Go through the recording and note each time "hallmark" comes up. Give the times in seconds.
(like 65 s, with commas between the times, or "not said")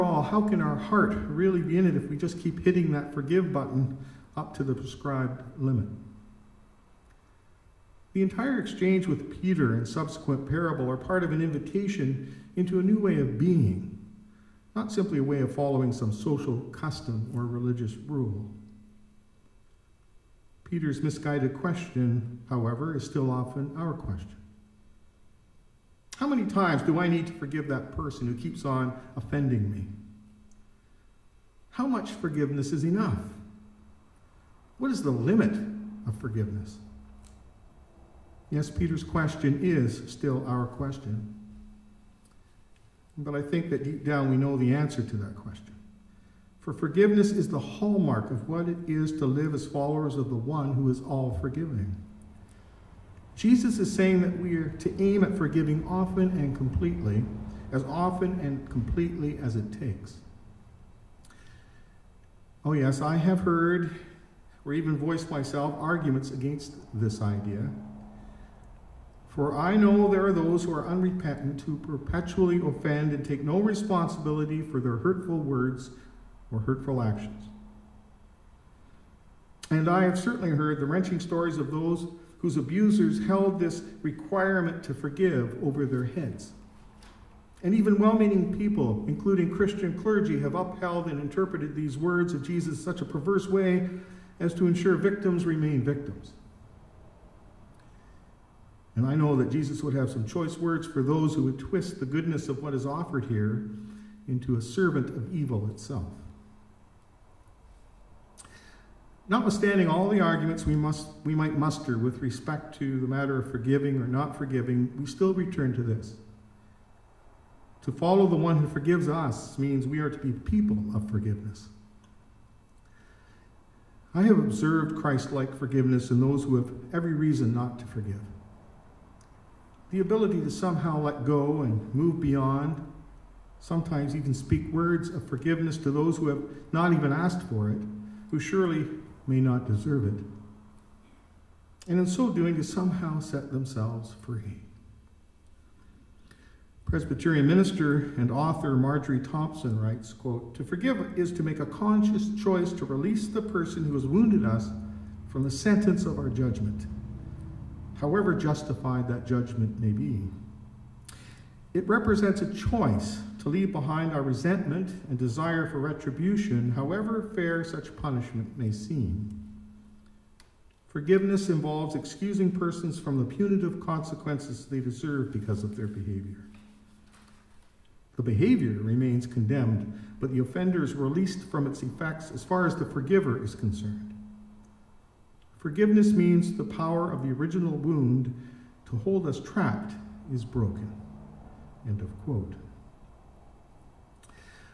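47 s.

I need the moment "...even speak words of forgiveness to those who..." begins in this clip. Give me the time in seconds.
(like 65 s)
134 s.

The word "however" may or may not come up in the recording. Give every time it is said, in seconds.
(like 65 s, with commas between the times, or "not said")
22 s, 158 s, 166 s.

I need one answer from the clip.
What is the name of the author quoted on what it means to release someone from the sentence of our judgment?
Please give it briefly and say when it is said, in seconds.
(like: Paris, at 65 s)
Marjorie Thompson, at 148 s.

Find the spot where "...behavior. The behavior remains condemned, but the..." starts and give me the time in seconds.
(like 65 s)
175 s.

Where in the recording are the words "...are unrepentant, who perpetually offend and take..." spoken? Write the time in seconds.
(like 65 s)
70 s.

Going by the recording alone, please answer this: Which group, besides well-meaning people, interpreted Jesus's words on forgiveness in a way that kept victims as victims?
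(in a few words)
Christian clergy.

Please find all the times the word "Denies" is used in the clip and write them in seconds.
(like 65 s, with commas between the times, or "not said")
not said.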